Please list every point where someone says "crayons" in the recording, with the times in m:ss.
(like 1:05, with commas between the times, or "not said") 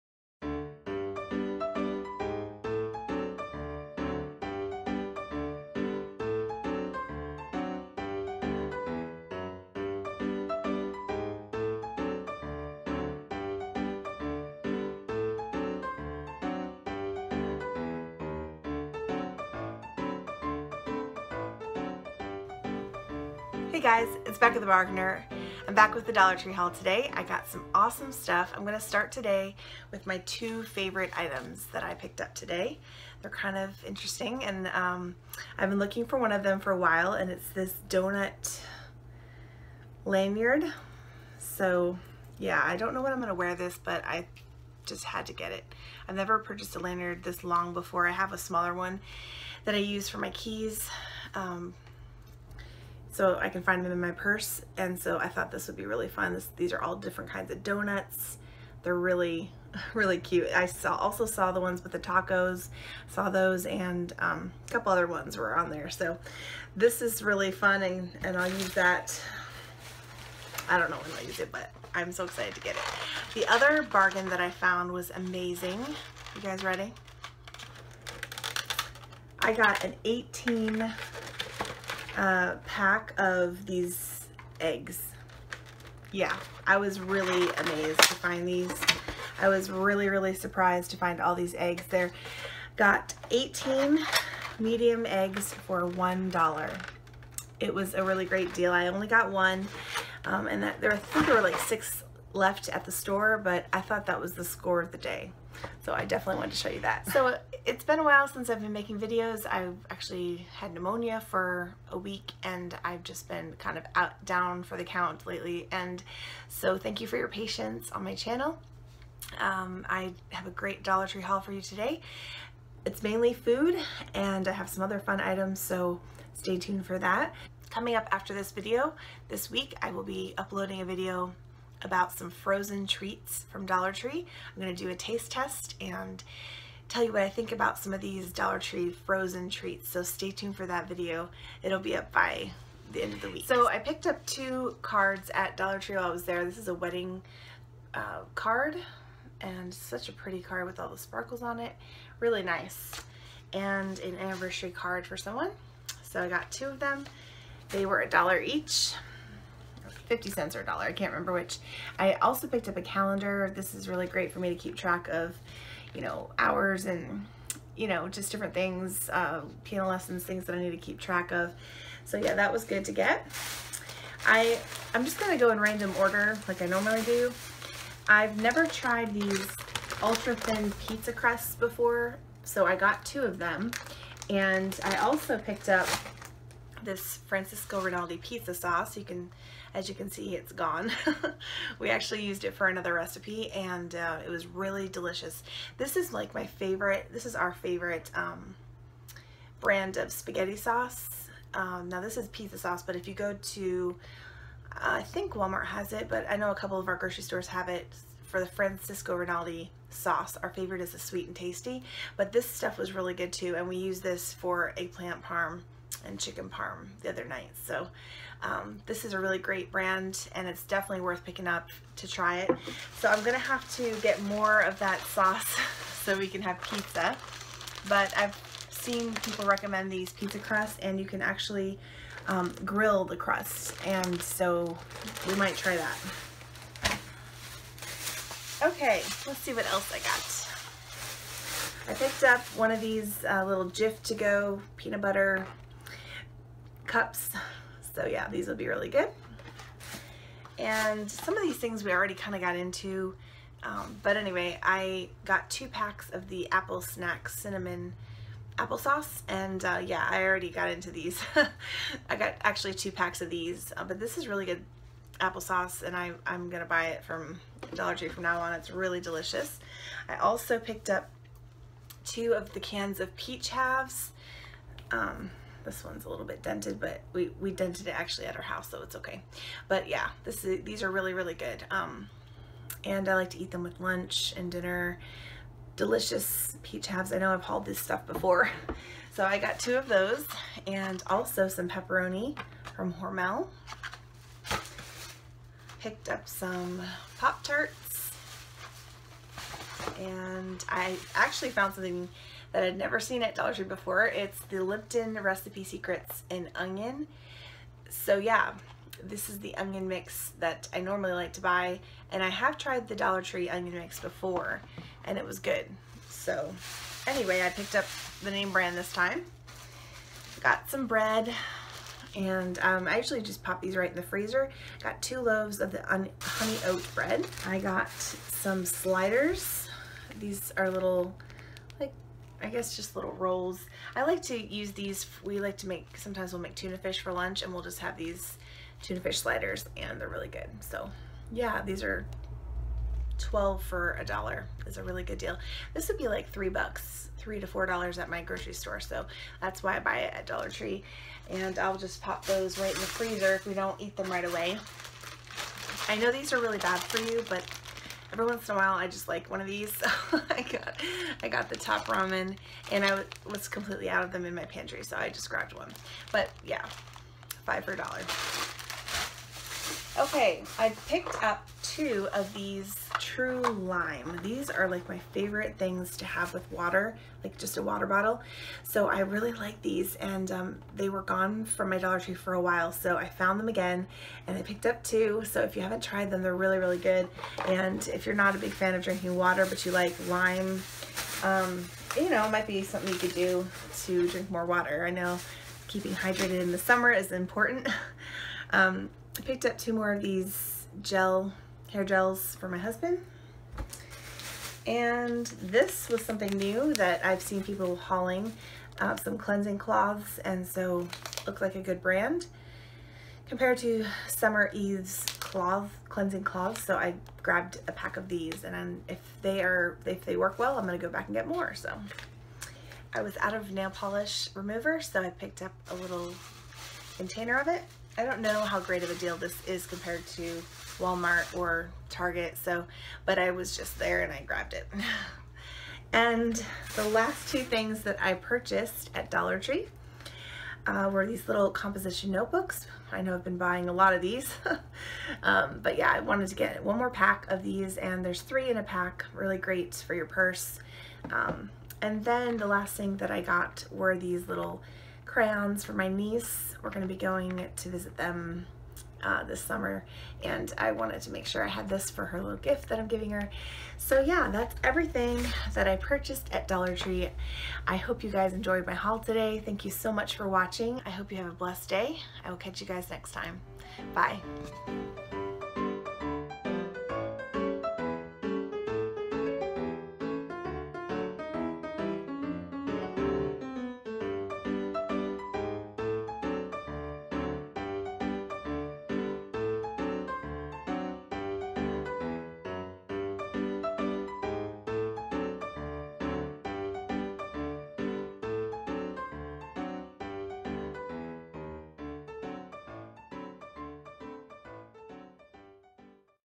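7:35.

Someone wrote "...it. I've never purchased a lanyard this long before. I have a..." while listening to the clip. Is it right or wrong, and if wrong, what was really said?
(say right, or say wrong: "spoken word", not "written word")
right.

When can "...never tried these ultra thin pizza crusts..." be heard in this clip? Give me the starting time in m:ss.
2:58.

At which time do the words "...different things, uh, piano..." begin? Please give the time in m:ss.
2:48.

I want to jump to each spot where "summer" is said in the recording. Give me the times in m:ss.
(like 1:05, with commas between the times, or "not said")
6:36, 6:54, 7:39.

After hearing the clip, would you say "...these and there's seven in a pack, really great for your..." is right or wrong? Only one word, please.
wrong.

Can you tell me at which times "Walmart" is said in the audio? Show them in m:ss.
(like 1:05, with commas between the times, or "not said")
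3:25, 7:10.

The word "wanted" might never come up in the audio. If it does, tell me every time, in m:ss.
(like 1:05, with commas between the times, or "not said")
1:46, 7:26, 7:40.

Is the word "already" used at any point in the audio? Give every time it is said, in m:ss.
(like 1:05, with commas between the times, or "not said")
4:11, 4:20.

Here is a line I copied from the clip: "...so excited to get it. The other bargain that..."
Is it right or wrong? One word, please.
right.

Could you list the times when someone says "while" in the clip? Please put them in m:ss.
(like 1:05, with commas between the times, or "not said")
0:36, 1:48, 2:25, 5:58, 6:22.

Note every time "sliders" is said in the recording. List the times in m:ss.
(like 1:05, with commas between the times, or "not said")
5:28, 5:39.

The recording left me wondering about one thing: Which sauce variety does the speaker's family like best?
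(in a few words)
Sweet and tasty.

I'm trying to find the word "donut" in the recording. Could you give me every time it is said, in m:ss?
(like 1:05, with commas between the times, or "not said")
0:37, 0:57.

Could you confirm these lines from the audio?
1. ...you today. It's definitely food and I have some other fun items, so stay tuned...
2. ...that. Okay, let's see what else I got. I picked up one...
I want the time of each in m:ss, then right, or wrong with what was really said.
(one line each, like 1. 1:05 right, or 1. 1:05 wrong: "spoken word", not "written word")
1. 2:01 wrong: "mainly", not "definitely"
2. 3:55 right.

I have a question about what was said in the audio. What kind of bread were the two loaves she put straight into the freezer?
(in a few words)
Honey oat.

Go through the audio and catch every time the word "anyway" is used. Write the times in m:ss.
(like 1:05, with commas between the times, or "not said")
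4:14, 5:17.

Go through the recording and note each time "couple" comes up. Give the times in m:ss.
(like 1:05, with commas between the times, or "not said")
1:04, 3:26.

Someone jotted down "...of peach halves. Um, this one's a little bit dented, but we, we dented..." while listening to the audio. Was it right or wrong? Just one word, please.
right.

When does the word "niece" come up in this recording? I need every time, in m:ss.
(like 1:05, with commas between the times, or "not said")
7:35.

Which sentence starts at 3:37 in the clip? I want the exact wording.
So um, this is a really great brand and it's definitely worth picking up to try it.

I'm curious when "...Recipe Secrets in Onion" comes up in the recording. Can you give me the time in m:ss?
5:05.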